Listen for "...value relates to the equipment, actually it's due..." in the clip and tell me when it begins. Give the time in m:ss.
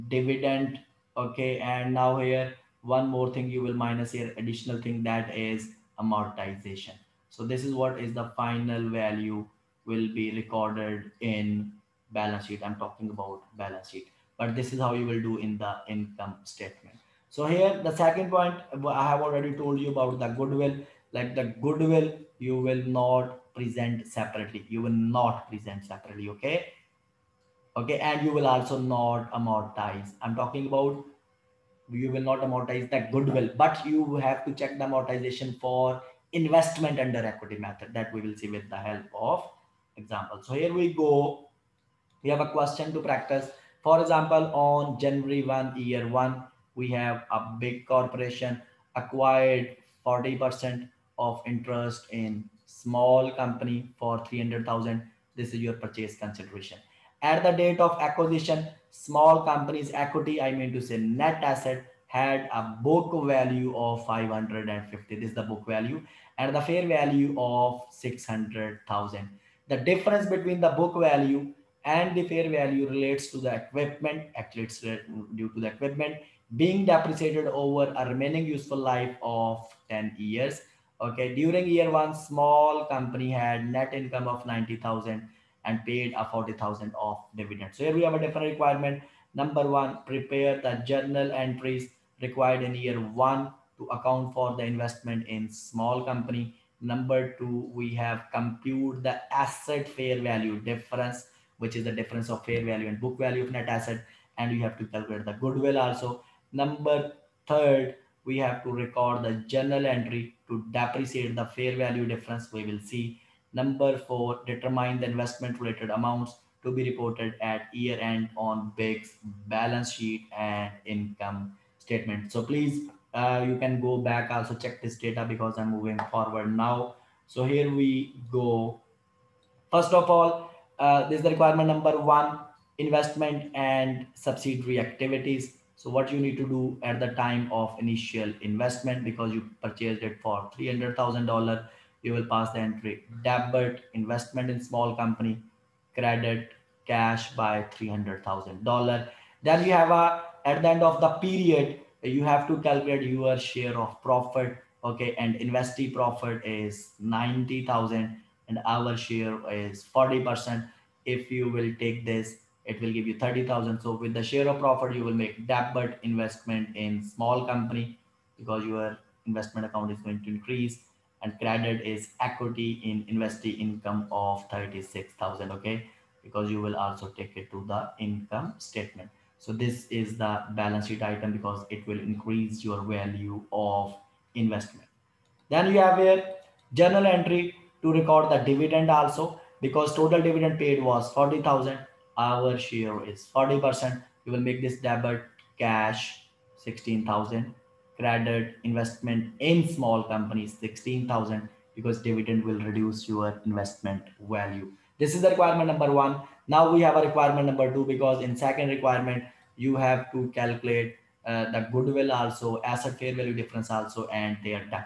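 1:12.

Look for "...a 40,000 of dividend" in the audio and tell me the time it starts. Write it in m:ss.
1:26.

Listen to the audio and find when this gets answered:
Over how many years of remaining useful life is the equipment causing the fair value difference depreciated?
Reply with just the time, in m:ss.
1:19.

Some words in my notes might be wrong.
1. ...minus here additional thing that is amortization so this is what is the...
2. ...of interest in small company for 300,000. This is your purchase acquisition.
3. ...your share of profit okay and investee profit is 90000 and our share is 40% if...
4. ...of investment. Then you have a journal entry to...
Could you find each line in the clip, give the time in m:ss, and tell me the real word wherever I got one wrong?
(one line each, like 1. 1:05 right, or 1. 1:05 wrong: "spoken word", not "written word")
1. 0:03 right
2. 0:51 wrong: "consideration", not "acquisition"
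3. 2:33 right
4. 3:03 right.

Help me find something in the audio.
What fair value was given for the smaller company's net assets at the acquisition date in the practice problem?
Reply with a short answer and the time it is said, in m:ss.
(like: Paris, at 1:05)
600,000, at 1:07.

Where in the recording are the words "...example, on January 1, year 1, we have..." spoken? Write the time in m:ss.
0:44.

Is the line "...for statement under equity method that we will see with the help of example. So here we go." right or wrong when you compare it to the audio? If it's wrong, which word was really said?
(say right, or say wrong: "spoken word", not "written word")
wrong: "investment", not "statement".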